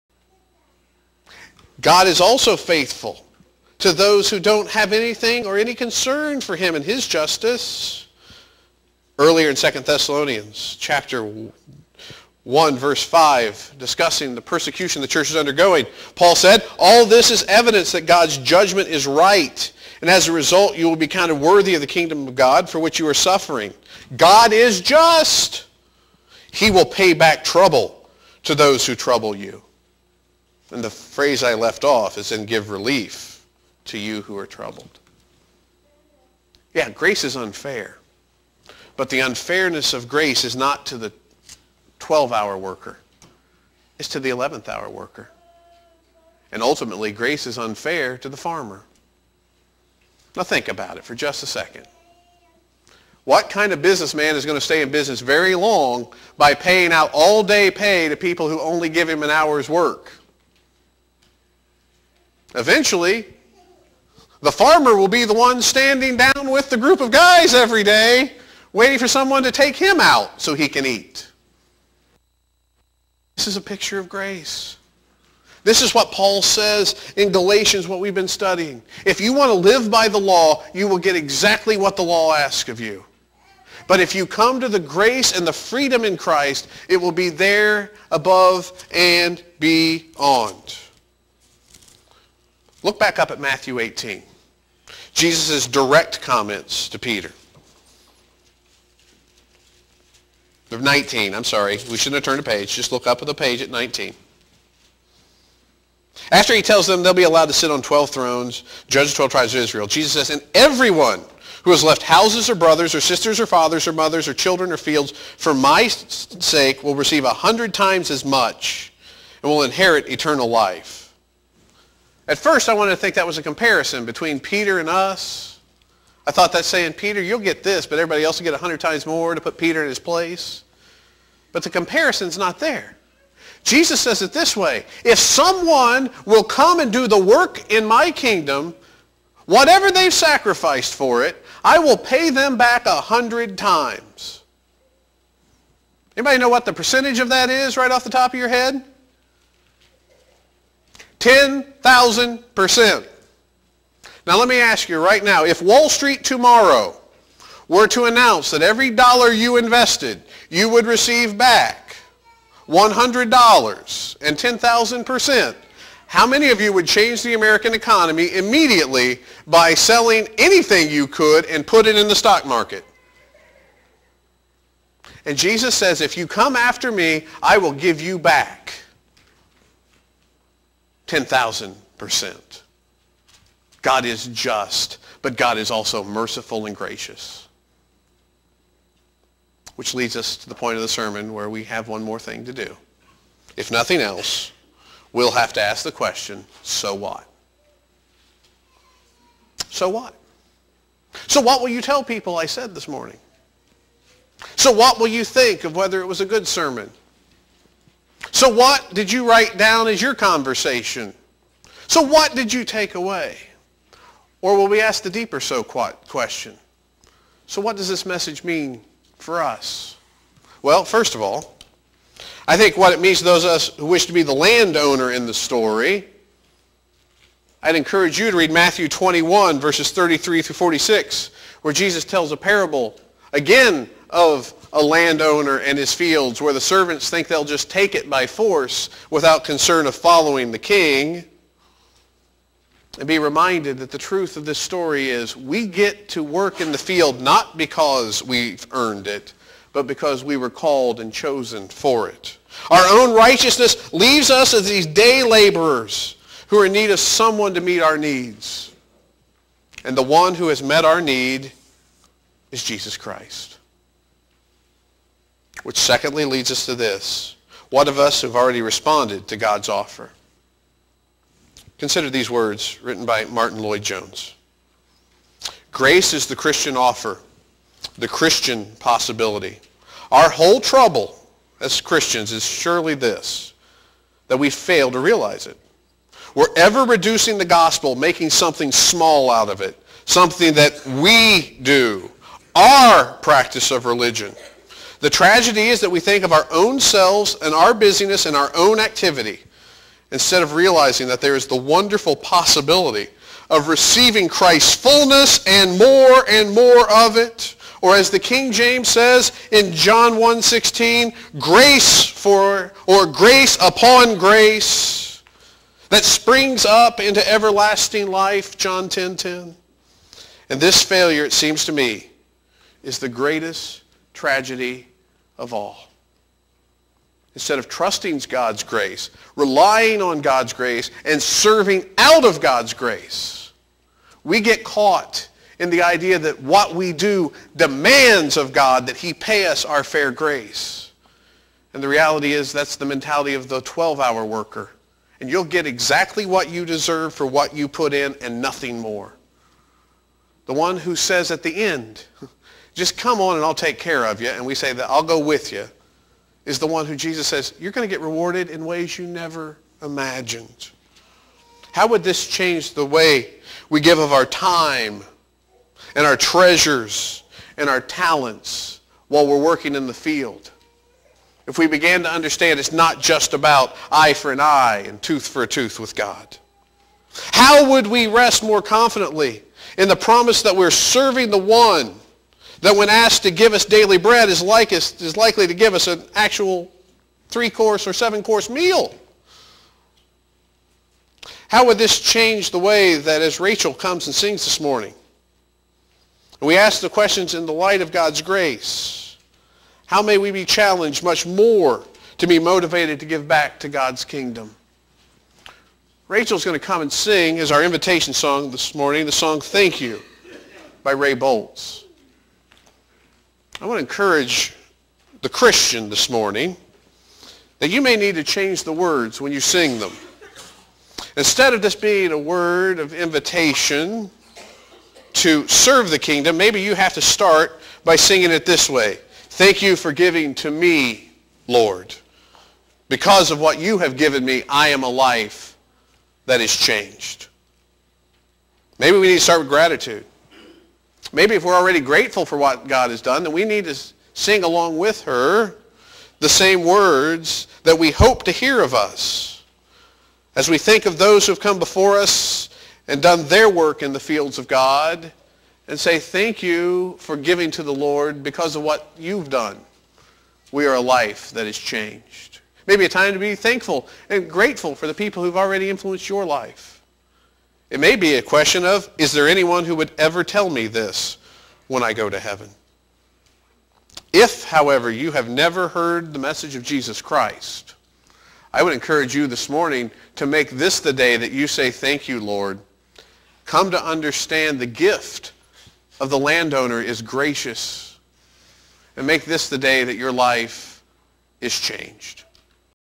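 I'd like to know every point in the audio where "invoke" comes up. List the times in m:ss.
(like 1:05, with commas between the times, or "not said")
not said.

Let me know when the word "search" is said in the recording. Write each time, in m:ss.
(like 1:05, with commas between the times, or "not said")
not said.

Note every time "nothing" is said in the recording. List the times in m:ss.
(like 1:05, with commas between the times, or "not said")
3:13, 5:48.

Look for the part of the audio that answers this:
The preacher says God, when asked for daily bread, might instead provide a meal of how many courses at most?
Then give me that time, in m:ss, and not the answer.
6:27.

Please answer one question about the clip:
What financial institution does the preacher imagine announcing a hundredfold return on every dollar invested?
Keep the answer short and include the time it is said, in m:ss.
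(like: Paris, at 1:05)
Wall Street, at 2:35.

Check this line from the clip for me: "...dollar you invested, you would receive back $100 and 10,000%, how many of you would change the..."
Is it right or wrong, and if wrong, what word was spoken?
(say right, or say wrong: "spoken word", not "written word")
right.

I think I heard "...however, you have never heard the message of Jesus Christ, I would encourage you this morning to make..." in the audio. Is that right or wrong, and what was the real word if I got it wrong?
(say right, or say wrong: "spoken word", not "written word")
right.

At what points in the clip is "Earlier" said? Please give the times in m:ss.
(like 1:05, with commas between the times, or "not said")
0:09.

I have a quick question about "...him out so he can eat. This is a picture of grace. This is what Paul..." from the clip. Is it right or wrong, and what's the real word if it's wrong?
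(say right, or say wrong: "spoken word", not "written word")
right.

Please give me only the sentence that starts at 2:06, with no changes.
I thought that's saying, Peter, you'll get this, but everybody else will get 100 times more to put Peter in his place.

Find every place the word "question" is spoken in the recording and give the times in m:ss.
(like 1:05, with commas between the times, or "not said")
3:15, 3:35, 6:36, 7:48.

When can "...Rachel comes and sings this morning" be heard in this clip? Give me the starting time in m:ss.
6:33.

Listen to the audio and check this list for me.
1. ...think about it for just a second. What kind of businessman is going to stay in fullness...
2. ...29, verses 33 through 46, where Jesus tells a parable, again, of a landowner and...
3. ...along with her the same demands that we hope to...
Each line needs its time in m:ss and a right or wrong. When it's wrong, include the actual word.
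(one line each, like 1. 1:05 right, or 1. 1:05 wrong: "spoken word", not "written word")
1. 0:50 wrong: "business", not "fullness"
2. 3:48 wrong: "21", not "29"
3. 7:24 wrong: "words", not "demands".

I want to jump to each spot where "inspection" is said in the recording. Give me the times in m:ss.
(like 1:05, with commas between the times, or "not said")
not said.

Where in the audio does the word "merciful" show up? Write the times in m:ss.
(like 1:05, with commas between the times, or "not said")
3:06.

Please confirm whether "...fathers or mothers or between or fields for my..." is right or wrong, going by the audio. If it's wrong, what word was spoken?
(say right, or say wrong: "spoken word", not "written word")
wrong: "children", not "between".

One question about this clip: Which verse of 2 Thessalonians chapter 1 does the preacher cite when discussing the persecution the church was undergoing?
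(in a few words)
5.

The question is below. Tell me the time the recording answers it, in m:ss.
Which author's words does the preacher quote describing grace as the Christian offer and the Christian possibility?
4:33.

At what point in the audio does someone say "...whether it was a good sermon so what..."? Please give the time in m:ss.
3:25.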